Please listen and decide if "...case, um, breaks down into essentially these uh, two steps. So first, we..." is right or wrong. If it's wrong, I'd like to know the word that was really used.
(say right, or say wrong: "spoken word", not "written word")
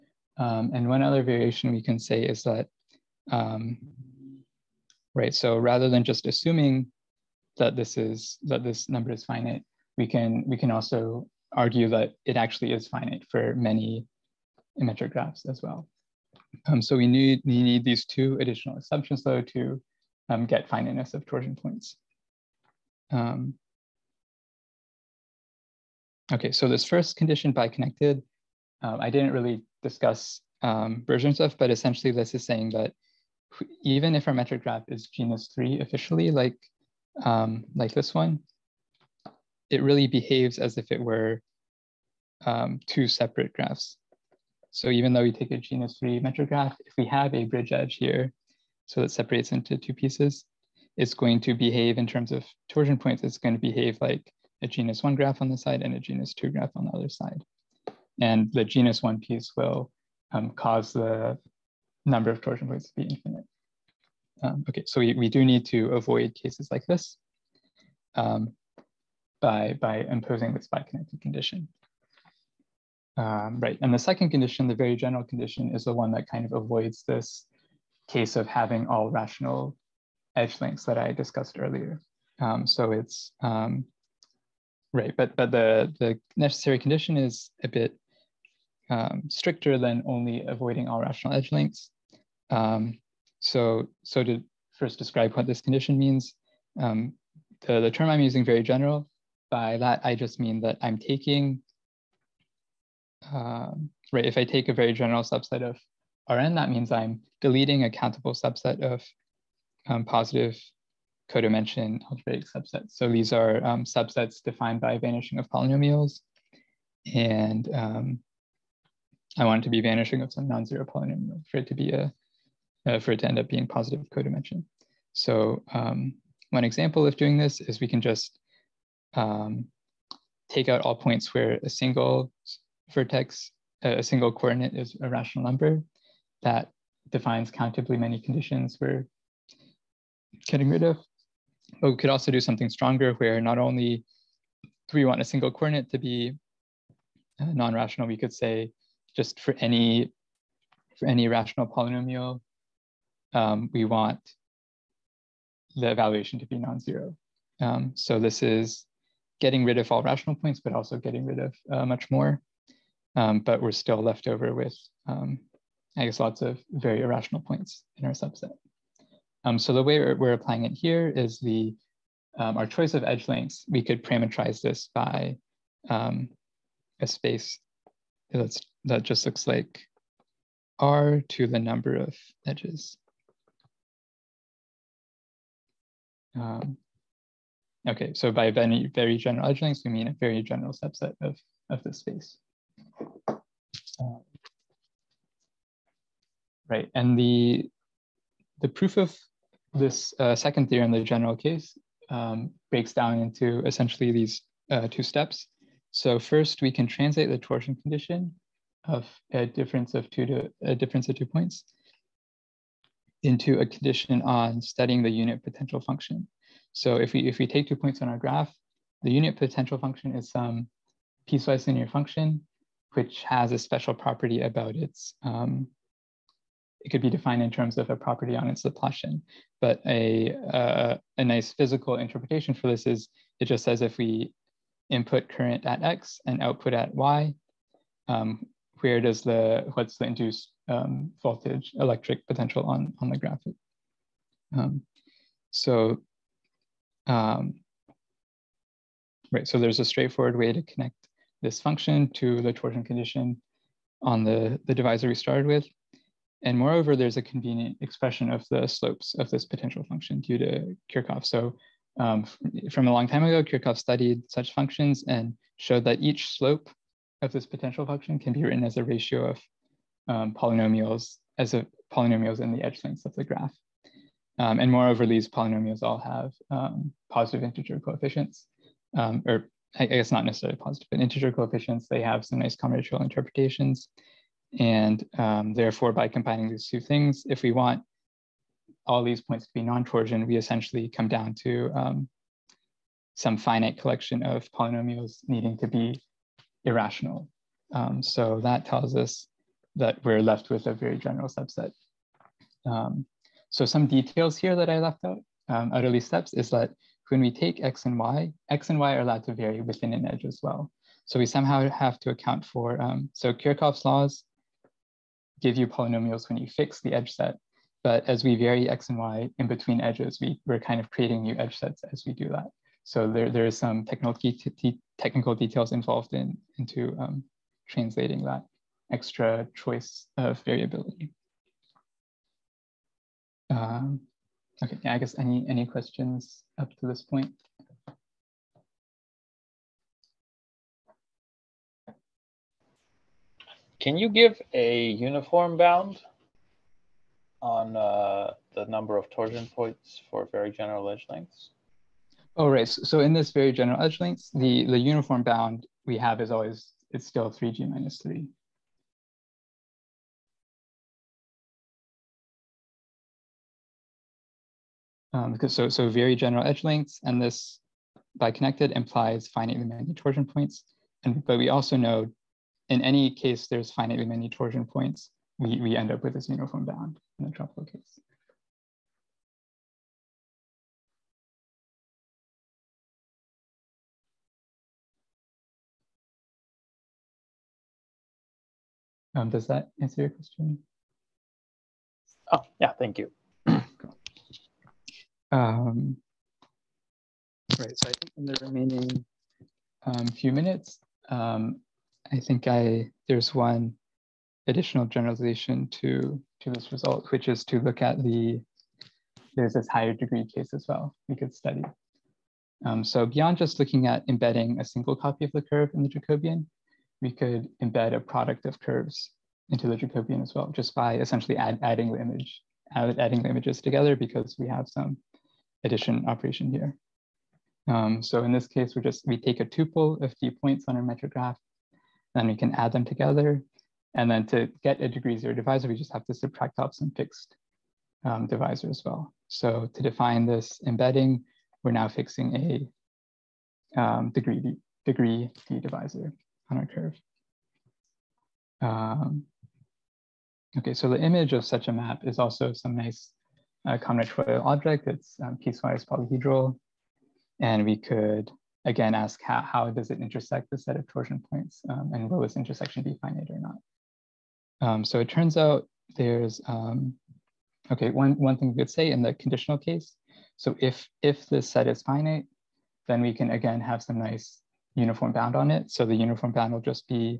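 right.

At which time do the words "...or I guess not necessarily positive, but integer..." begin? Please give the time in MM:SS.
04:39.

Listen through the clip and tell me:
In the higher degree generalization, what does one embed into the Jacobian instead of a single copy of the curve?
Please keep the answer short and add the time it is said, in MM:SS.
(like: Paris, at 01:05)
A product of curves, at 06:57.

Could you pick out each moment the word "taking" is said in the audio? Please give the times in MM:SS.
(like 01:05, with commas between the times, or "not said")
01:40.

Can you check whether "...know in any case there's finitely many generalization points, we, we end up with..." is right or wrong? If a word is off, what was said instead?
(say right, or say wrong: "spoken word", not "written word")
wrong: "torsion", not "generalization".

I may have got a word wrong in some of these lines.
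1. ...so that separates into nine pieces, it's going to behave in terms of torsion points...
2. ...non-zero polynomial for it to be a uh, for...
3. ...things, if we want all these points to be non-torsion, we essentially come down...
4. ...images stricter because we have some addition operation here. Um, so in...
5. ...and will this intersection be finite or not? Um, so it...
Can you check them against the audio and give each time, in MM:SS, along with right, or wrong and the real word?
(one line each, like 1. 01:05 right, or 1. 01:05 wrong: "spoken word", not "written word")
1. 00:48 wrong: "two", not "nine"
2. 02:00 right
3. 04:46 right
4. 07:03 wrong: "together", not "stricter"
5. 07:41 right.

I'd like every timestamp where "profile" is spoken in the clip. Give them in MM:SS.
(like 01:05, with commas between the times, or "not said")
not said.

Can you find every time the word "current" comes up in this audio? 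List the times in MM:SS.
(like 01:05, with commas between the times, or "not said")
03:55.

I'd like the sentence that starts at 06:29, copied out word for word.
Um, does that answer your question?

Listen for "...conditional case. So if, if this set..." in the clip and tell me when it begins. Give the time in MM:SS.
07:49.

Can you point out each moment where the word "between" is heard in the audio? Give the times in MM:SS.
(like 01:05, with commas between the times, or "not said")
05:19.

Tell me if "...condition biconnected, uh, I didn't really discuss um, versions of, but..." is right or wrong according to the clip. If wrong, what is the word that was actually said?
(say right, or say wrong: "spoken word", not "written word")
right.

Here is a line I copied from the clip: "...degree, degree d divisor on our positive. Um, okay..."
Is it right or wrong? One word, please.
wrong.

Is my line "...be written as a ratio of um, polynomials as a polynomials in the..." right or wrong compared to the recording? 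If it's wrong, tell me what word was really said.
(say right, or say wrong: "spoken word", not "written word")
right.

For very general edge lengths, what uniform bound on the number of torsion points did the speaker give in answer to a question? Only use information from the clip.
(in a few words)
3g - 3.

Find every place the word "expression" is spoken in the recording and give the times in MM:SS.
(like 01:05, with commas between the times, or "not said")
04:17.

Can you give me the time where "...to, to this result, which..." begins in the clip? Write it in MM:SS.
06:45.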